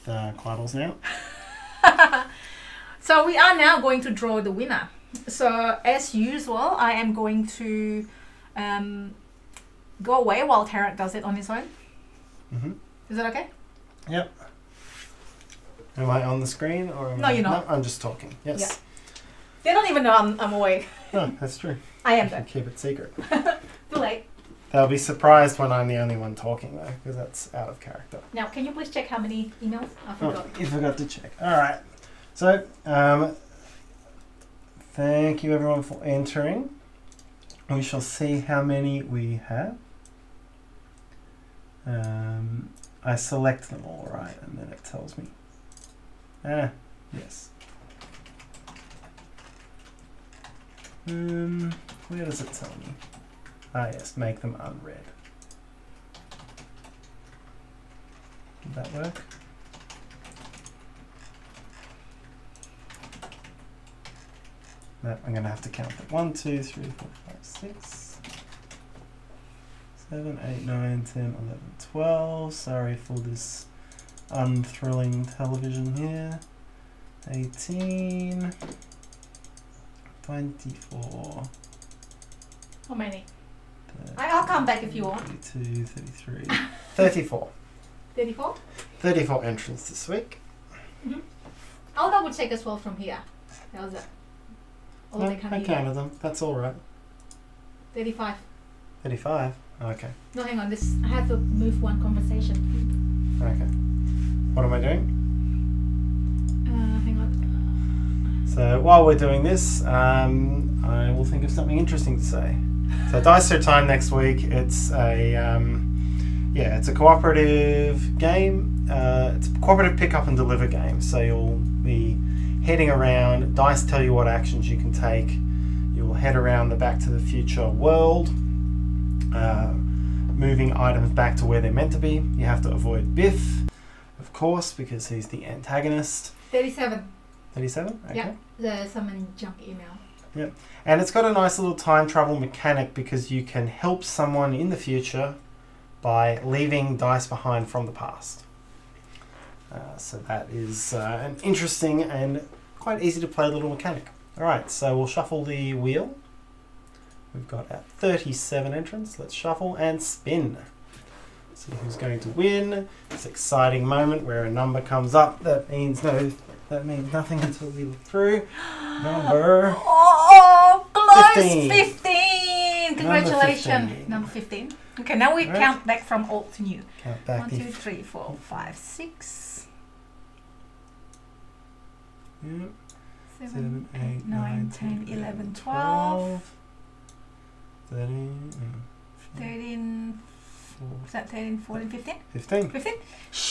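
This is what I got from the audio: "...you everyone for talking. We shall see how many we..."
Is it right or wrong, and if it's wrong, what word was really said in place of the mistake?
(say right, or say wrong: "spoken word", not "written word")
wrong: "entering", not "talking".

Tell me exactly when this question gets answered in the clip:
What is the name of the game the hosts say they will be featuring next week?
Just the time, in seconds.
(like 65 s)
113 s.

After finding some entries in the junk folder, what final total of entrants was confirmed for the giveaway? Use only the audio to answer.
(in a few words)
37.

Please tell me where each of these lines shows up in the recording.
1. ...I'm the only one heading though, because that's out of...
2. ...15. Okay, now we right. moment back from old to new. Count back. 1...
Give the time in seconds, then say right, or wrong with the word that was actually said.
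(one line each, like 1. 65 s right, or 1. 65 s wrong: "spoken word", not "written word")
1. 25 s wrong: "talking", not "heading"
2. 174 s wrong: "count", not "moment".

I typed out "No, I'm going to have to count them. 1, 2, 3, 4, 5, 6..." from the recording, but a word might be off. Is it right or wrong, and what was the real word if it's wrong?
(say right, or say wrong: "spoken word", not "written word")
right.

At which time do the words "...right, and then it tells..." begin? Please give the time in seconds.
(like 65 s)
44 s.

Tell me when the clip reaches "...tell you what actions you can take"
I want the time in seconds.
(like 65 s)
123 s.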